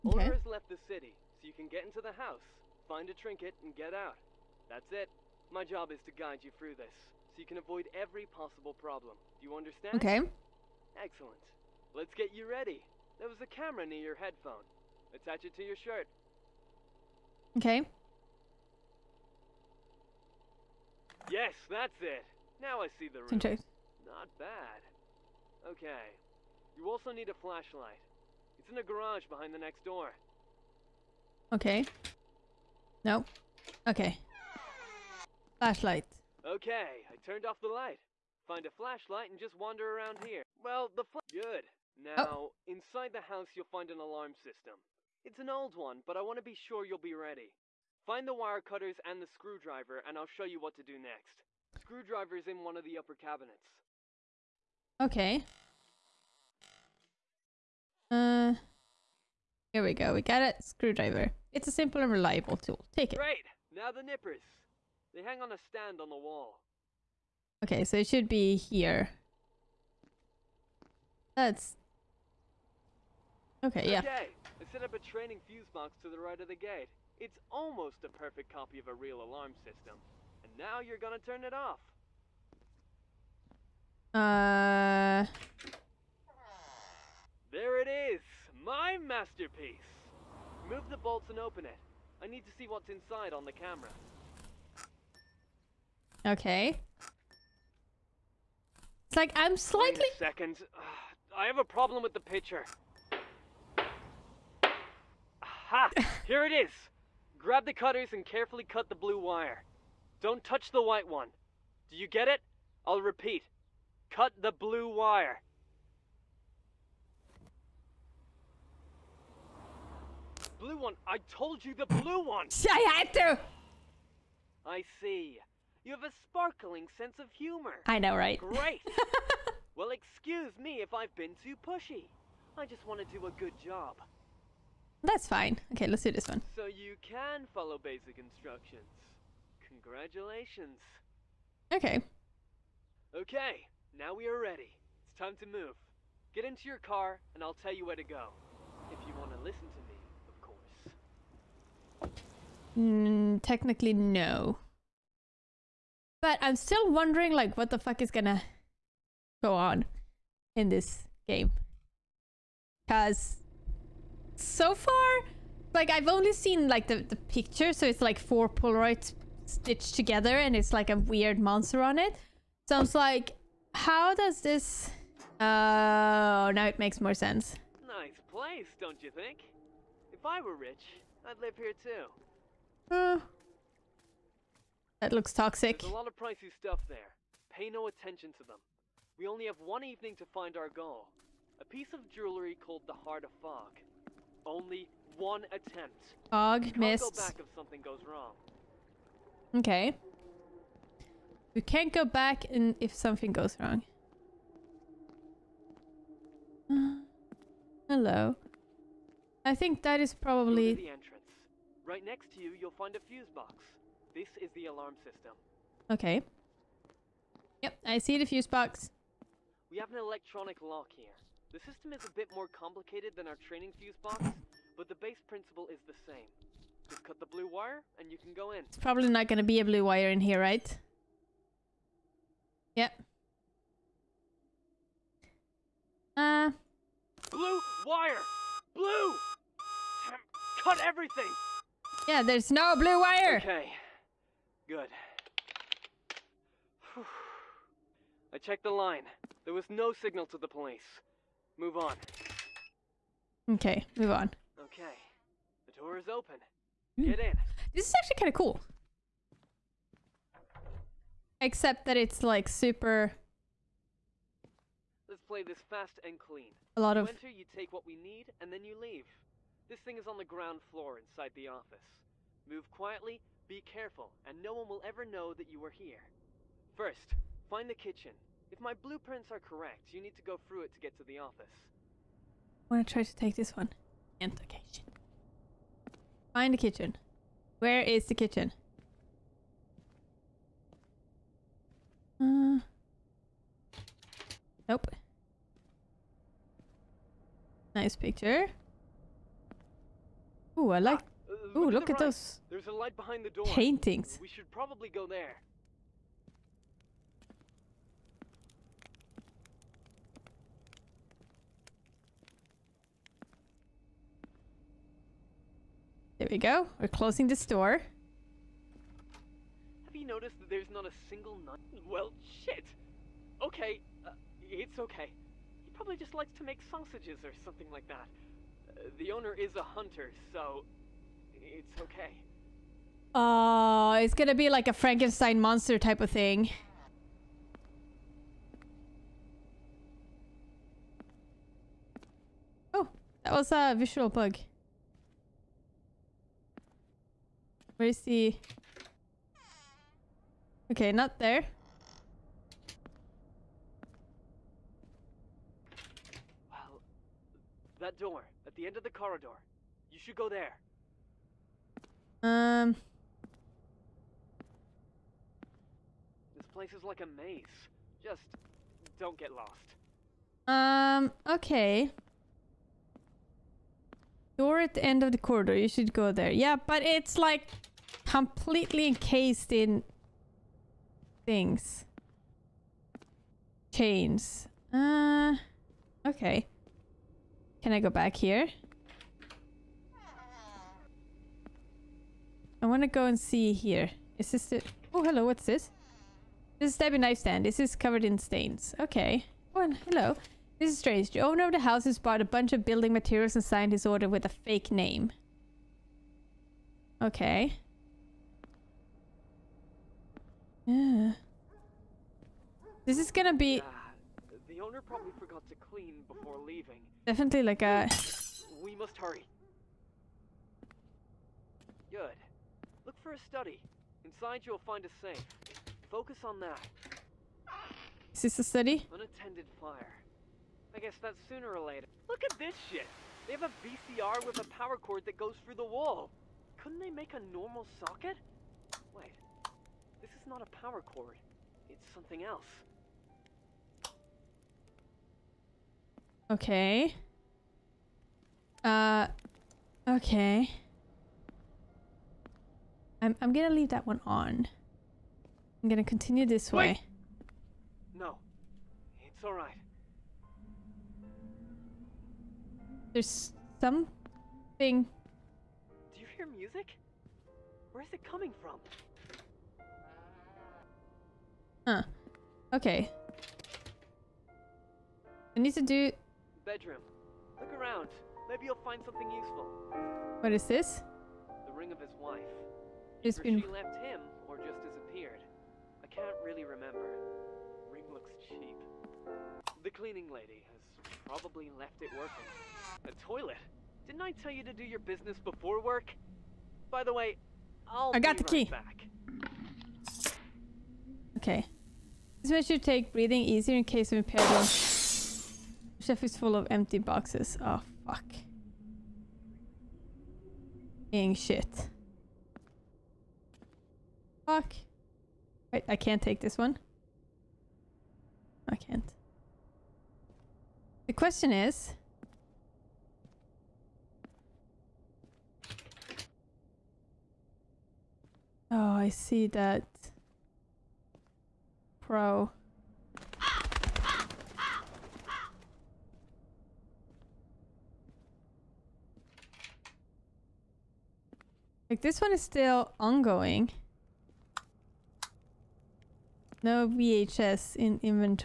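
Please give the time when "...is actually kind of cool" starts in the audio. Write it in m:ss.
4:17.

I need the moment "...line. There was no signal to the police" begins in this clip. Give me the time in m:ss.
4:08.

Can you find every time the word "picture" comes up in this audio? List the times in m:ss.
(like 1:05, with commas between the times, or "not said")
1:42, 2:47, 4:57.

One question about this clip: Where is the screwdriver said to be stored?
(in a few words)
Upper cabinets.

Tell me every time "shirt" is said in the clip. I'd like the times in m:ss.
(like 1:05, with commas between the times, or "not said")
0:15.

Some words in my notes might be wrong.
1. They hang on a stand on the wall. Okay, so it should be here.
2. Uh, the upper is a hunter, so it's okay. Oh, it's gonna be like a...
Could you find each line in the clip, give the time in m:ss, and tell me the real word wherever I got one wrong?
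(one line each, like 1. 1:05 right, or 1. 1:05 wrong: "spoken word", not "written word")
1. 1:05 right
2. 5:28 wrong: "owner", not "upper".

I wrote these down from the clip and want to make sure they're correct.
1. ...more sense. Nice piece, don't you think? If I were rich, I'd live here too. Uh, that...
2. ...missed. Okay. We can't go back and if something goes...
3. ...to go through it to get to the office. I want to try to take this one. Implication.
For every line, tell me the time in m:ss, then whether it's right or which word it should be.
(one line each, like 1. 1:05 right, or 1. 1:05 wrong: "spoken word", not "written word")
1. 2:57 wrong: "place", not "piece"
2. 3:16 right
3. 4:40 right.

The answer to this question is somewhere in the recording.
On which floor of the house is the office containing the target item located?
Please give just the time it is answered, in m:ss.
4:30.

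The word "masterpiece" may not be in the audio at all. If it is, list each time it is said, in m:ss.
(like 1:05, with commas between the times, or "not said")
1:28.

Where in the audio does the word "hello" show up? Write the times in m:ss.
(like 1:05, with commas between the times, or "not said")
3:27, 6:35, 6:39.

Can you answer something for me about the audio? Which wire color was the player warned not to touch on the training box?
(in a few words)
White.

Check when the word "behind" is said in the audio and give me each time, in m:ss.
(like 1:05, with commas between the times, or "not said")
0:29, 5:02.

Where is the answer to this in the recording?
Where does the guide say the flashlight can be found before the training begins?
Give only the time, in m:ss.
0:28.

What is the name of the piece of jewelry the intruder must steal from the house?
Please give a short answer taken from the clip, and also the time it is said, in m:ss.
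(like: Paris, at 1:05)
Heart of Fog, at 3:13.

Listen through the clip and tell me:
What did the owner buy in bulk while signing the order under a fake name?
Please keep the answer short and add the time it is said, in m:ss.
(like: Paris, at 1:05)
Building materials, at 6:42.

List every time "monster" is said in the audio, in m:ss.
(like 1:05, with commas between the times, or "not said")
2:51, 5:35.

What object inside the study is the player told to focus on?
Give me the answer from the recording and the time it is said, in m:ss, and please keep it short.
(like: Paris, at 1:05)
A safe, at 7:04.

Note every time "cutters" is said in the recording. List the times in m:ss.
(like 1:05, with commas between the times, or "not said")
0:48, 1:47.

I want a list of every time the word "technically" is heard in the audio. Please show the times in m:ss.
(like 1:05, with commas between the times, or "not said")
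2:33.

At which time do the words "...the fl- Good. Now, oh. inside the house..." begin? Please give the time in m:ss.
0:40.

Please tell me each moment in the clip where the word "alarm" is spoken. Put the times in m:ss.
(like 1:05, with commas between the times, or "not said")
0:43, 1:19, 3:34.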